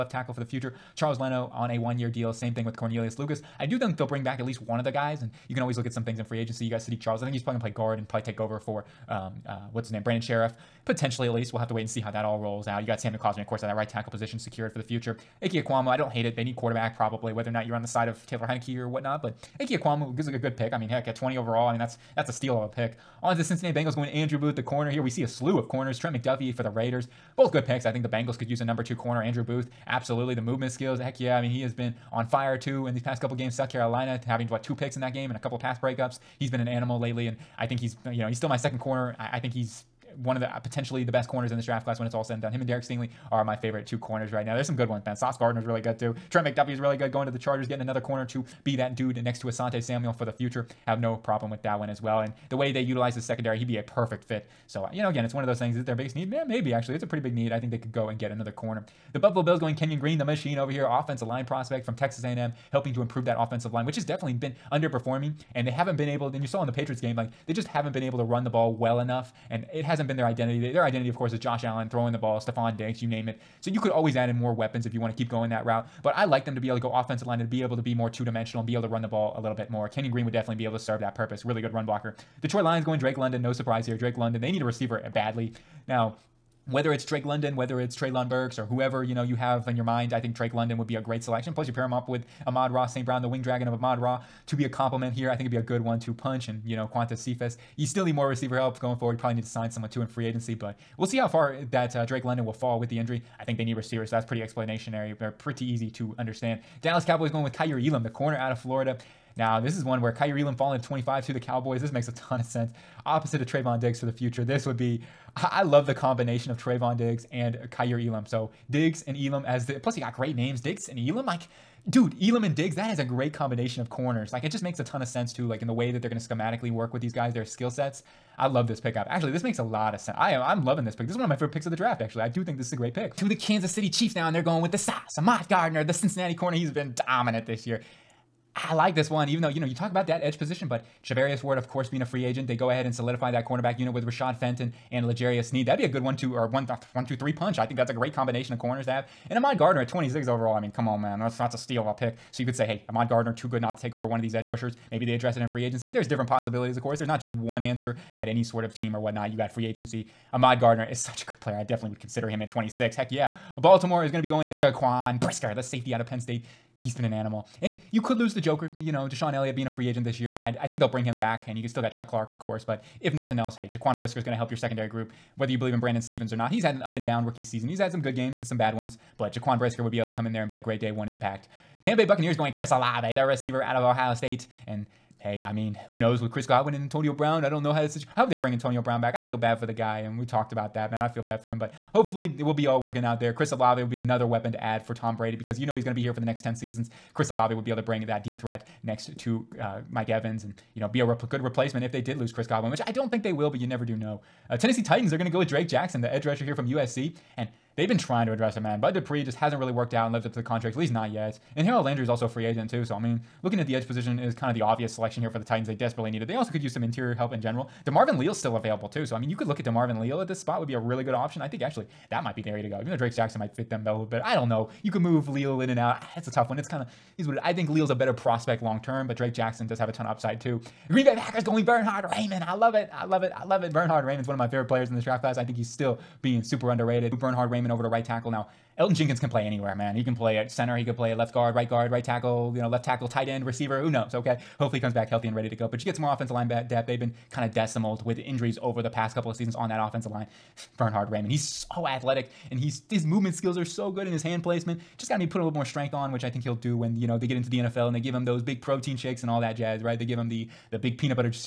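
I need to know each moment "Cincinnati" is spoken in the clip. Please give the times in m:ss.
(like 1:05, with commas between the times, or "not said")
0:23, 2:15.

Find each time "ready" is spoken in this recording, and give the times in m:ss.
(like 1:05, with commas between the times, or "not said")
4:05.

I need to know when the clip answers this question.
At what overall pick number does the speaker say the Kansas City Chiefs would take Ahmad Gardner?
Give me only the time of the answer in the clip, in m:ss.
2:29.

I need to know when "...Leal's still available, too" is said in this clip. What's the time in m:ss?
3:38.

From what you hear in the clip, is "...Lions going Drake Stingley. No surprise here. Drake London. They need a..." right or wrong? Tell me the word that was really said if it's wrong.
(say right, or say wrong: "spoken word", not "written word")
wrong: "London", not "Stingley".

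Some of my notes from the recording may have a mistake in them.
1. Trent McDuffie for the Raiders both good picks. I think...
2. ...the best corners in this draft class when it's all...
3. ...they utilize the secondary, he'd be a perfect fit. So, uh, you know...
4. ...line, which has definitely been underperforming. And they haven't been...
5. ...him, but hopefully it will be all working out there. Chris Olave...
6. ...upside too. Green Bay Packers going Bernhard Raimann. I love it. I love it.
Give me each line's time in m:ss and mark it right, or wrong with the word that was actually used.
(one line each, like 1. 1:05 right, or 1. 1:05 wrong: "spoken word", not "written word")
1. 0:25 right
2. 0:41 right
3. 0:52 right
4. 1:03 right
5. 3:11 right
6. 3:50 right.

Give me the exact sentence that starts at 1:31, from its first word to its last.
Plus, you pair him up with Amon-Ra St.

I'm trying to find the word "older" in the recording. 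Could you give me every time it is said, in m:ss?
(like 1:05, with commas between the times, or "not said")
not said.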